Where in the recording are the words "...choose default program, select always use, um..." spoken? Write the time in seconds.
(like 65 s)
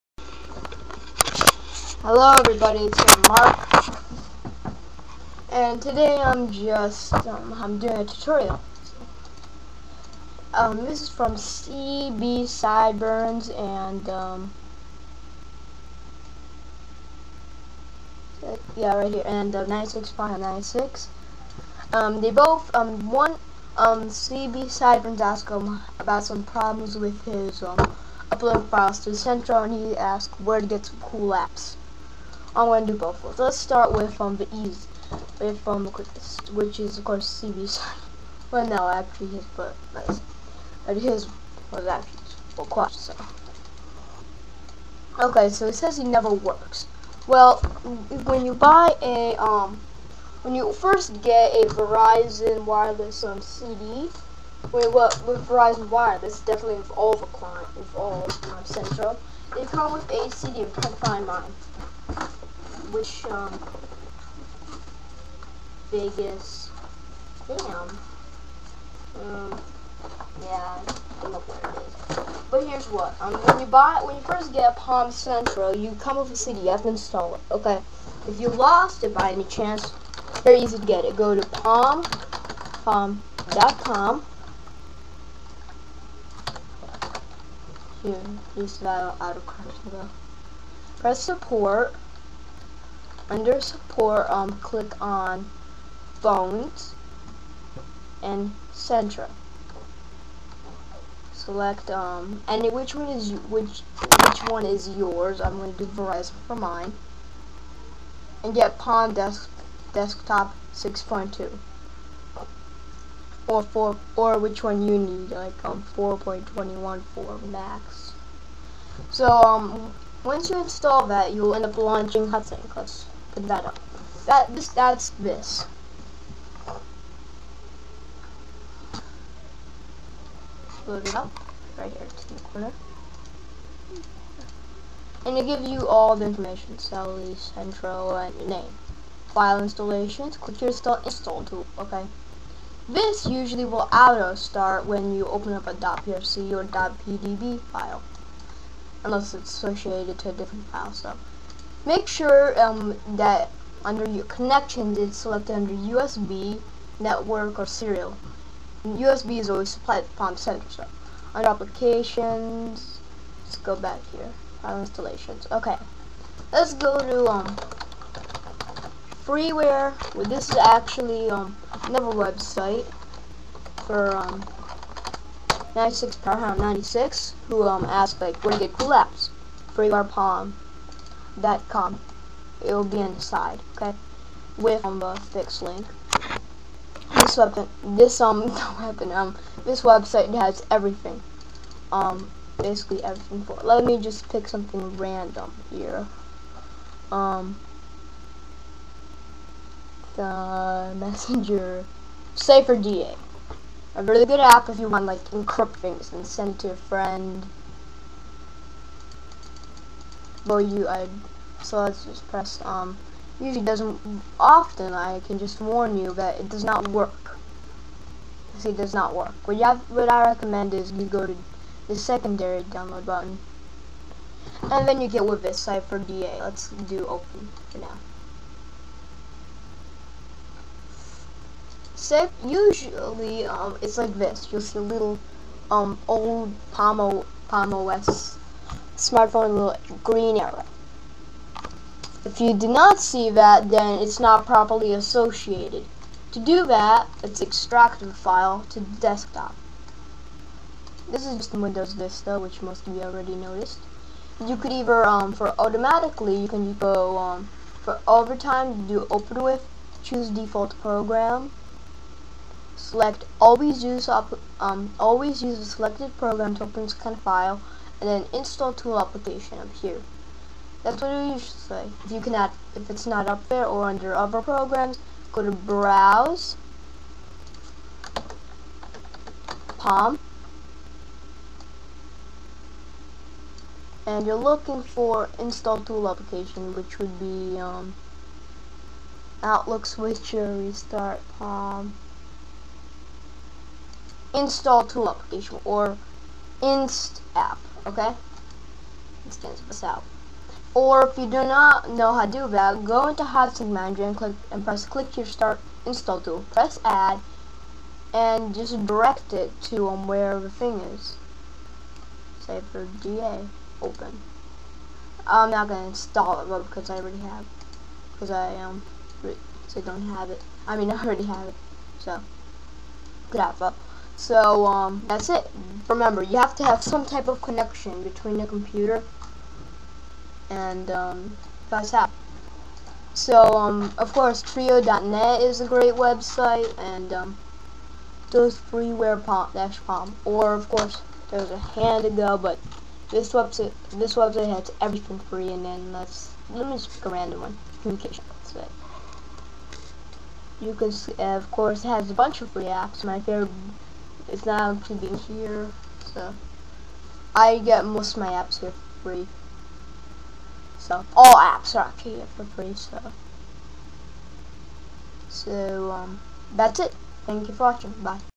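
260 s.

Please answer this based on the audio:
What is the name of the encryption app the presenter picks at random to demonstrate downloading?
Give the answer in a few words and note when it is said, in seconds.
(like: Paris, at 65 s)
Cipher DA, at 225 s.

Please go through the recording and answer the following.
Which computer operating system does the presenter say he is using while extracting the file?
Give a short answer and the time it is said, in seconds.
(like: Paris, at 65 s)
Windows Vista, at 251 s.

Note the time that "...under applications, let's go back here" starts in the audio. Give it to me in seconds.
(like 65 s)
161 s.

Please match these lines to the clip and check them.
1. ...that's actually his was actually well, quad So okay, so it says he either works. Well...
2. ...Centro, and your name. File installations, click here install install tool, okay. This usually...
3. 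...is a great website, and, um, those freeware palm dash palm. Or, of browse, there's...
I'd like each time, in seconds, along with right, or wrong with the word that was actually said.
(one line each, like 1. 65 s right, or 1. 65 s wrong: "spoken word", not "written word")
1. 39 s wrong: "never", not "either"
2. 137 s right
3. 335 s wrong: "course", not "browse".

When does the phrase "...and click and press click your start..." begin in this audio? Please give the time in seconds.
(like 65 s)
304 s.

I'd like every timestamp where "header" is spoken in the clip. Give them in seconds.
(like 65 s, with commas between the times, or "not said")
not said.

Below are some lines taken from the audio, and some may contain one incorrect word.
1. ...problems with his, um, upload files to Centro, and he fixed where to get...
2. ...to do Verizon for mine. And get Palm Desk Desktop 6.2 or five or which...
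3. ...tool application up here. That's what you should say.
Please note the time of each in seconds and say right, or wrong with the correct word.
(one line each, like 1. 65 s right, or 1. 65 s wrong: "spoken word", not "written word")
1. 26 s wrong: "asked", not "fixed"
2. 105 s wrong: "four", not "five"
3. 268 s right.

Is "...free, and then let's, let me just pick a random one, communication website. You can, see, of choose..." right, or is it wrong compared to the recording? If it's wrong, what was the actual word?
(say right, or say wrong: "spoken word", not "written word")
wrong: "course", not "choose".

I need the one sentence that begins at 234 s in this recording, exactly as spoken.
You'll see a little um, old pomo pomo Palm OS smartphone little green arrow.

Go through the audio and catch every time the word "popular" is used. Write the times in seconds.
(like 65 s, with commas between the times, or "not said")
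not said.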